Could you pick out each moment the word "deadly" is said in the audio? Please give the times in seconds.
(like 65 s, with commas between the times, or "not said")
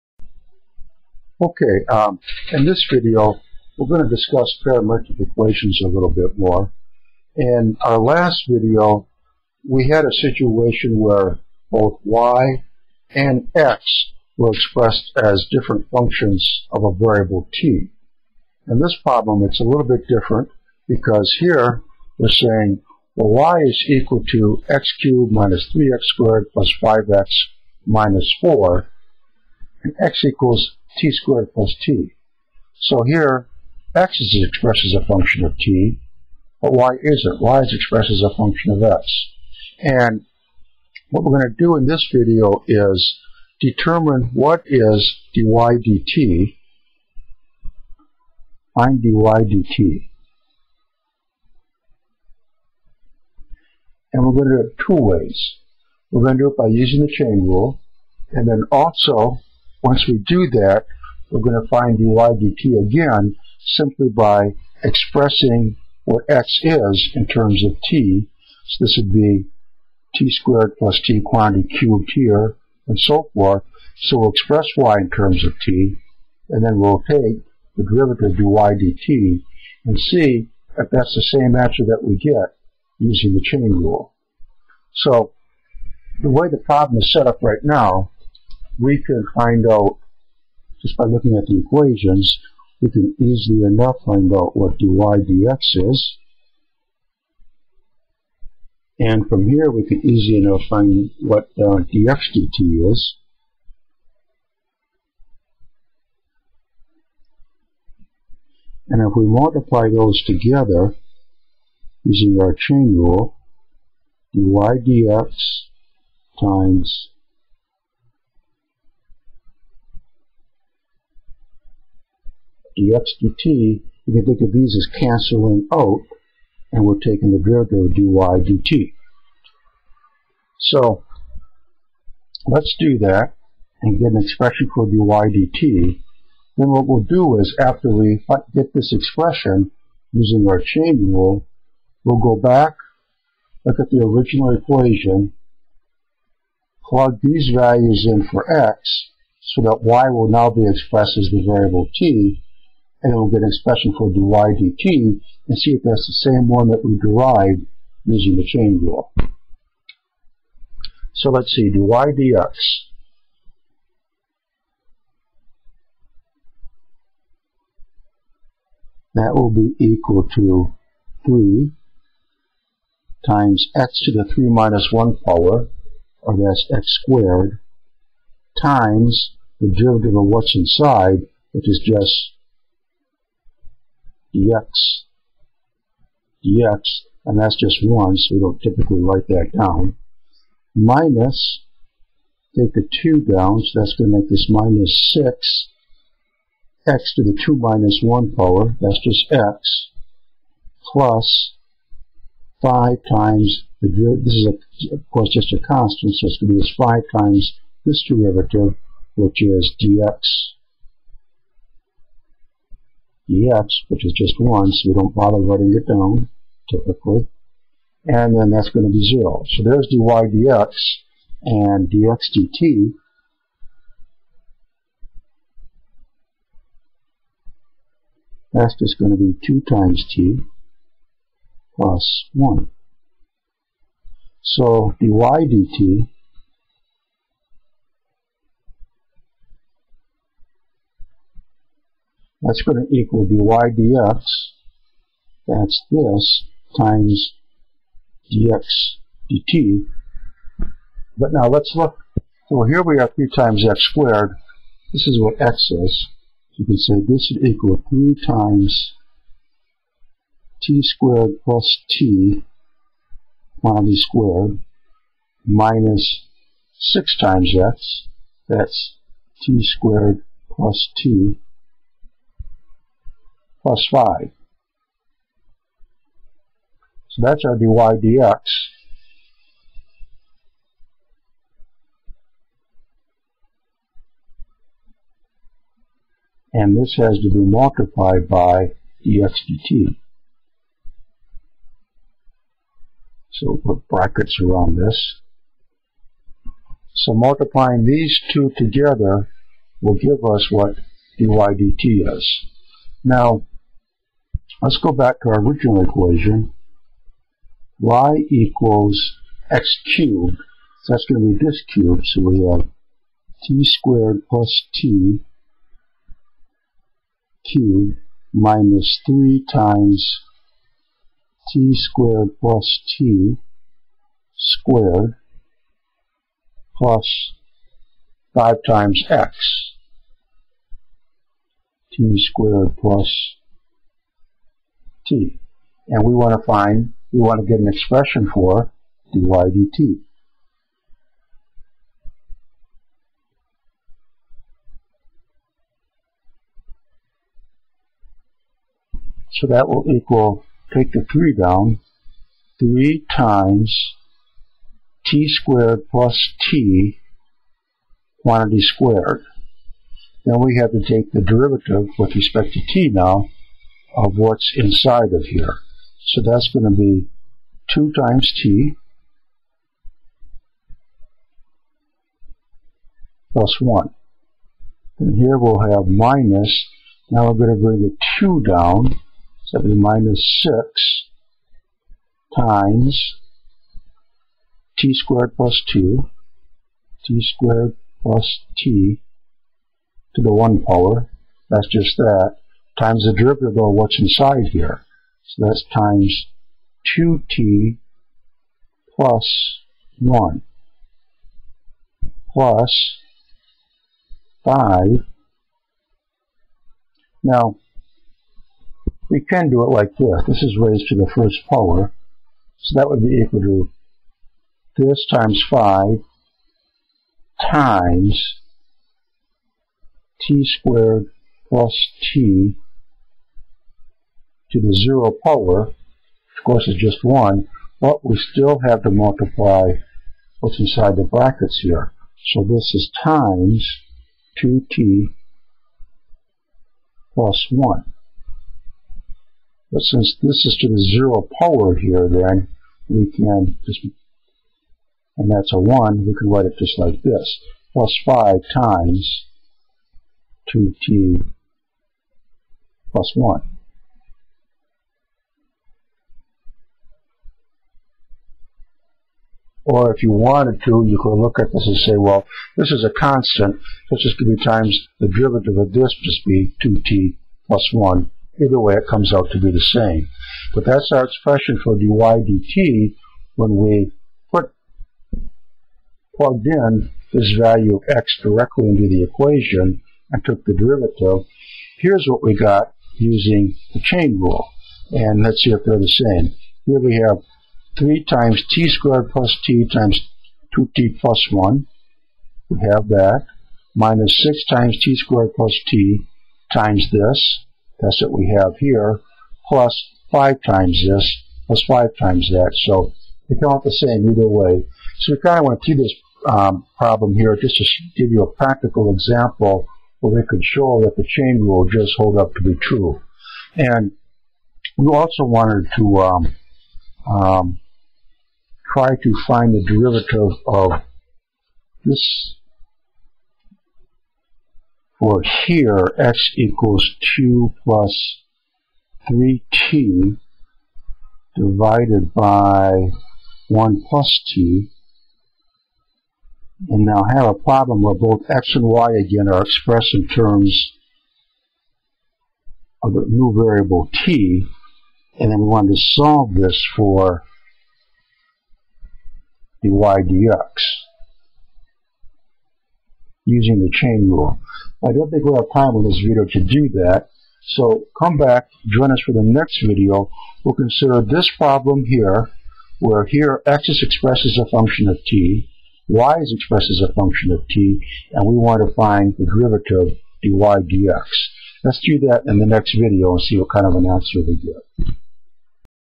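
not said.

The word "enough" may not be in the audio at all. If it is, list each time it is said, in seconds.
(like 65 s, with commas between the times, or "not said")
93 s, 100 s.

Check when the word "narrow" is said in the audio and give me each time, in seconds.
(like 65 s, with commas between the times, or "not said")
not said.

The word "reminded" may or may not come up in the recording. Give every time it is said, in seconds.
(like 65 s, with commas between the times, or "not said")
not said.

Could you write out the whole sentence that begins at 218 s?
And then that's going to be 0.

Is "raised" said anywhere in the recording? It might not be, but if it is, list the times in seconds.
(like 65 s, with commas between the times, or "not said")
410 s.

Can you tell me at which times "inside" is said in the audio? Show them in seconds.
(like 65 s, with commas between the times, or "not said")
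180 s, 364 s, 393 s, 430 s.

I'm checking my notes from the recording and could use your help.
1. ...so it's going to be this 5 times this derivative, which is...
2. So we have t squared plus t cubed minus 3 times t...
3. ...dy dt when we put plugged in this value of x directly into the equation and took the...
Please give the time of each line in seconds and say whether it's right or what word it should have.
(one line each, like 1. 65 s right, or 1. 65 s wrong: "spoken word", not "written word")
1. 206 s right
2. 312 s right
3. 471 s right.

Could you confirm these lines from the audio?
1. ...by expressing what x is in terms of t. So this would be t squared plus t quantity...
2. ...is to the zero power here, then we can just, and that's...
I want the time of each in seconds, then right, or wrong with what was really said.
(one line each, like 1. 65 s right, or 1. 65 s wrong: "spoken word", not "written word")
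1. 64 s right
2. 440 s right.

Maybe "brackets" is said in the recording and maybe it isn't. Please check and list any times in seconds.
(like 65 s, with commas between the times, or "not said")
293 s, 431 s.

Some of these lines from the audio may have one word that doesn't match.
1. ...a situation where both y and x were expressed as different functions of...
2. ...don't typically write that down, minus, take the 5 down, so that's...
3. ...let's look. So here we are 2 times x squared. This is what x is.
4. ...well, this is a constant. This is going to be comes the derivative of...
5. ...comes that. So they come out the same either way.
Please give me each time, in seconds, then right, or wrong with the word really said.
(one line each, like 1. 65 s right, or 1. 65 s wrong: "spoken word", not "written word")
1. 10 s right
2. 188 s wrong: "2", not "5"
3. 251 s wrong: "3", not "2"
4. 461 s wrong: "times", not "comes"
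5. 501 s wrong: "times", not "comes".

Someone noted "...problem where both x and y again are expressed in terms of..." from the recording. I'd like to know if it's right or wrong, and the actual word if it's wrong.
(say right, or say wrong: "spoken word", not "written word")
right.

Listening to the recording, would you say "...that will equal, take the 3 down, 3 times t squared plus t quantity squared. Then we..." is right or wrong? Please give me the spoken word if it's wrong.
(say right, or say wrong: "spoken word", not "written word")
right.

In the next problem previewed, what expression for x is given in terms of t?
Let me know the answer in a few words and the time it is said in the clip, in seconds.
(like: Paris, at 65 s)
(2 + 3t)/(1 + t), at 527 s.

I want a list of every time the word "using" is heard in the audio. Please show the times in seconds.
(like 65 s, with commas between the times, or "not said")
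56 s, 82 s, 112 s, 140 s, 158 s, 482 s, 553 s.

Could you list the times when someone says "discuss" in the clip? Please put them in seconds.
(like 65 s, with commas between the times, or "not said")
4 s.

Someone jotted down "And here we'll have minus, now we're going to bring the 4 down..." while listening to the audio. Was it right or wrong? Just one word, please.
wrong.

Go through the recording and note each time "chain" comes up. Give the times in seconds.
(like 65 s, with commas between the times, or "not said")
57 s, 83 s, 112 s, 140 s, 158 s, 483 s, 511 s, 553 s.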